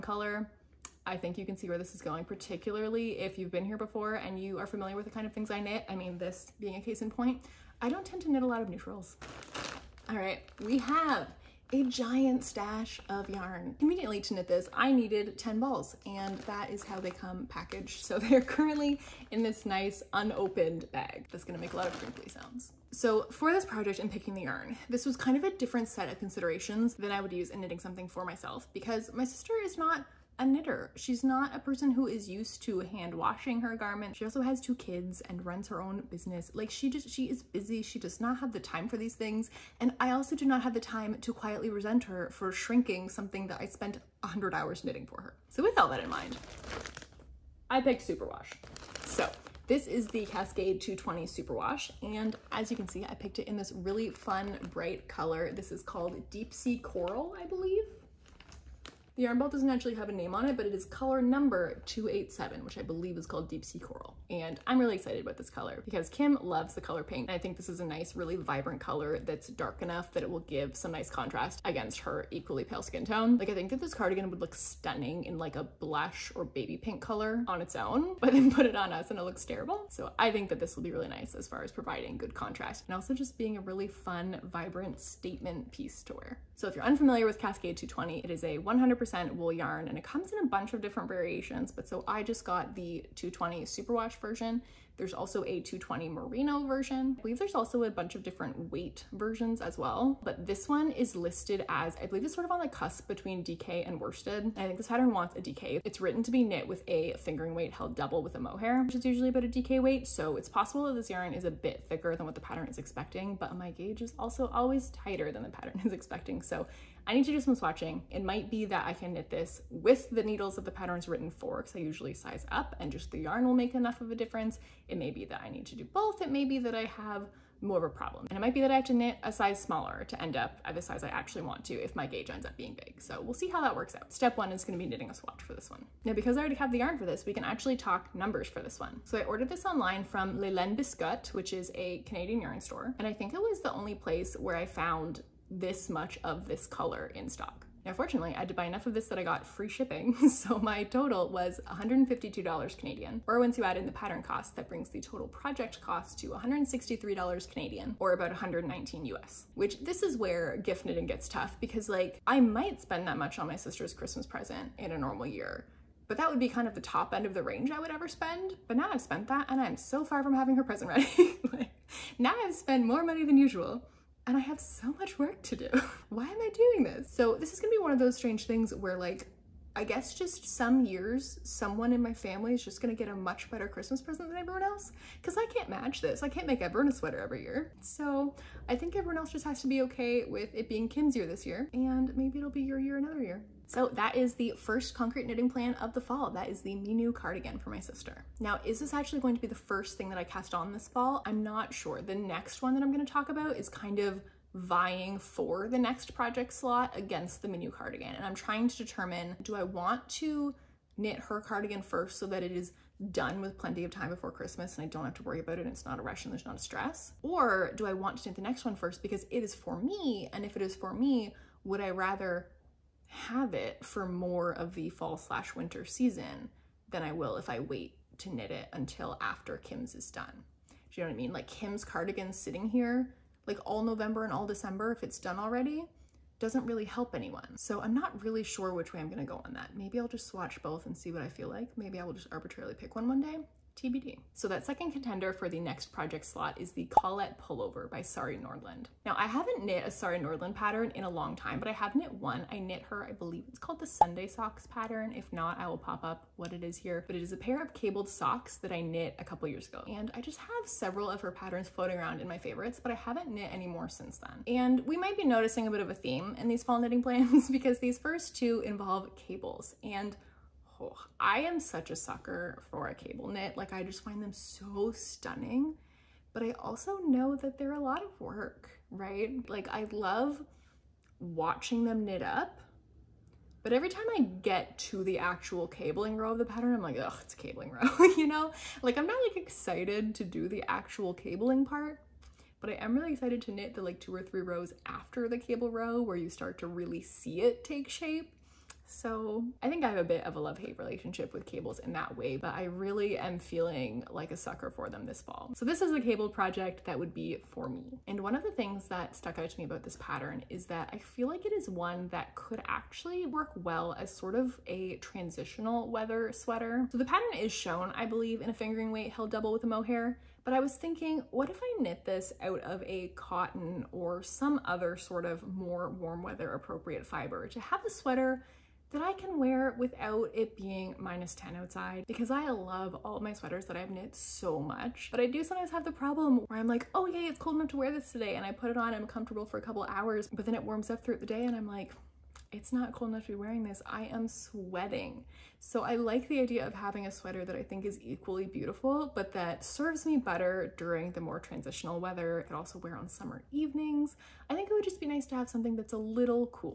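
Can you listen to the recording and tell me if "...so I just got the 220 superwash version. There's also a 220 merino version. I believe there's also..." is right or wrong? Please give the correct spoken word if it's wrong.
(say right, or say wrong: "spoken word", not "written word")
right.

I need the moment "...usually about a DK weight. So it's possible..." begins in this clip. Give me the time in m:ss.
1:49.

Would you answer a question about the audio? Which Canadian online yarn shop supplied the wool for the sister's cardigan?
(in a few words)
Leland Biscuit.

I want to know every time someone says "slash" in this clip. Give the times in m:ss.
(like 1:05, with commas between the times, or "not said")
3:45.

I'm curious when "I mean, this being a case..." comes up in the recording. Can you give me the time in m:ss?
0:05.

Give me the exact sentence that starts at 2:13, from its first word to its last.
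So we'll see how that works out.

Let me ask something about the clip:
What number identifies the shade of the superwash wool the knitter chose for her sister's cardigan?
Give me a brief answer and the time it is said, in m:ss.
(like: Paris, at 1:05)
287, at 1:01.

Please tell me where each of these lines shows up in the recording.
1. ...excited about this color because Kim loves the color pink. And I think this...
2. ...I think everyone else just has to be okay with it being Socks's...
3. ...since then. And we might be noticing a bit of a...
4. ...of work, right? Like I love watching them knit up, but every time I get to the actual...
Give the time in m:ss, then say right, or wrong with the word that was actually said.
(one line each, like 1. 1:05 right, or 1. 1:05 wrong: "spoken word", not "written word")
1. 1:04 right
2. 3:08 wrong: "Kim", not "Socks"
3. 4:23 right
4. 4:38 right.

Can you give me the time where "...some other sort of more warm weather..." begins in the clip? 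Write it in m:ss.
5:24.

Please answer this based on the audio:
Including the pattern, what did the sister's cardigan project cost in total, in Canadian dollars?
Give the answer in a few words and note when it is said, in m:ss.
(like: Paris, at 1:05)
$163, at 2:36.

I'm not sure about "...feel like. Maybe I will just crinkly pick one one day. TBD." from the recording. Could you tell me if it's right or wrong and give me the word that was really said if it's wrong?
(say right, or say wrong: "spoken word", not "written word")
wrong: "arbitrarily", not "crinkly".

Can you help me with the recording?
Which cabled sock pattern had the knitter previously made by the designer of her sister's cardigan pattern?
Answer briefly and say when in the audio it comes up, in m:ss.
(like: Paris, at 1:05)
Sunday Socks, at 4:13.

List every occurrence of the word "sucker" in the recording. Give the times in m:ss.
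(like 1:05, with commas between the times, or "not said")
4:31, 5:04.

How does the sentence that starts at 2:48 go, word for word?
But now I've spent that and I'm so far from having her present ready.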